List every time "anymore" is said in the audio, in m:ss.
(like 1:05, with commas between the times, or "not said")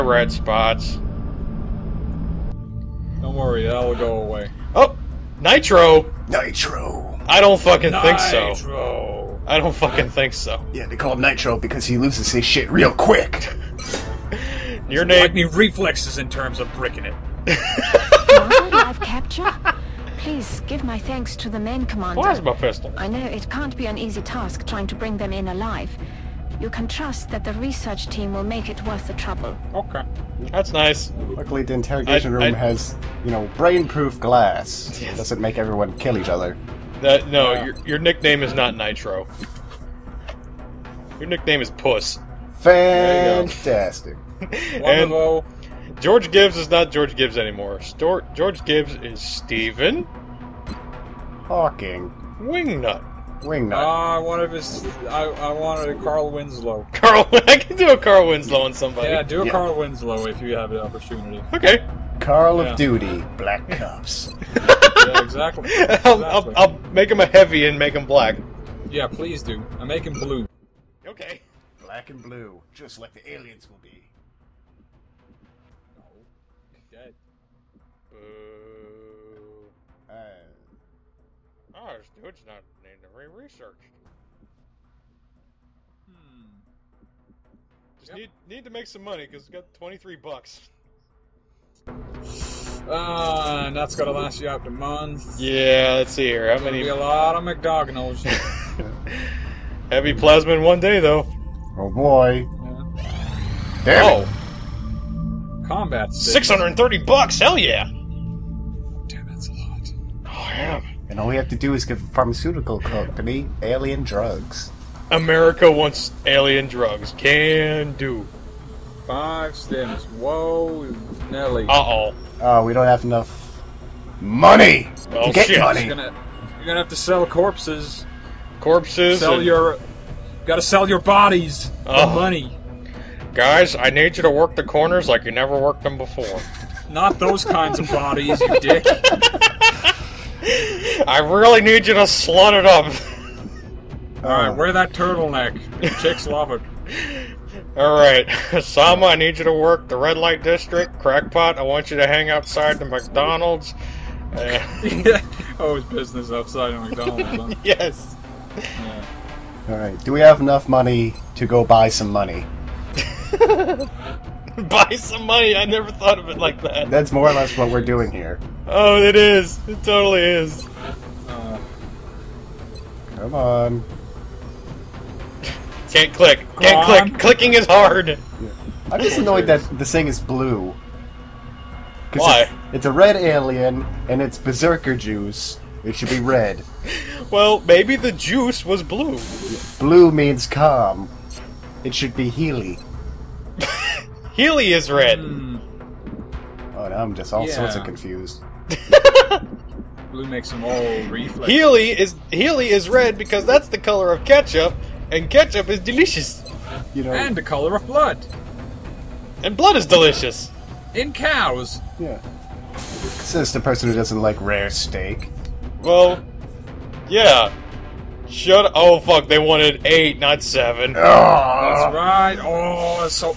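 0:47.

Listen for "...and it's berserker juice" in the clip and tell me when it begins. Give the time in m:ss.
3:04.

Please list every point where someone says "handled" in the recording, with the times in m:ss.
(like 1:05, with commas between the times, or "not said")
not said.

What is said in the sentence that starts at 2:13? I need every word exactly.
Guys, I need you to work the corners like you never worked them before.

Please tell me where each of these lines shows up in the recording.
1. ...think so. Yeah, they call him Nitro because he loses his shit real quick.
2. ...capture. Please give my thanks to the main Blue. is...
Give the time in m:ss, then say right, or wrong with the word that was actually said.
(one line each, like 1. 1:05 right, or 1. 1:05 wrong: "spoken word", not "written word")
1. 0:10 right
2. 0:18 wrong: "Commander", not "Blue".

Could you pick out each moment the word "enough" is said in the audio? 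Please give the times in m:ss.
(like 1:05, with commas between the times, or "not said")
2:03, 2:40.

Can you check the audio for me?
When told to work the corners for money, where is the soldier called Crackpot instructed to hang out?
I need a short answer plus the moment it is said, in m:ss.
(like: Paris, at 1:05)
Outside the McDonald's, at 2:32.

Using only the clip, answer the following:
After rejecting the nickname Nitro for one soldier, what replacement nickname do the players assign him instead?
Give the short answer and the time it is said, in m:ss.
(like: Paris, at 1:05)
Puss, at 0:41.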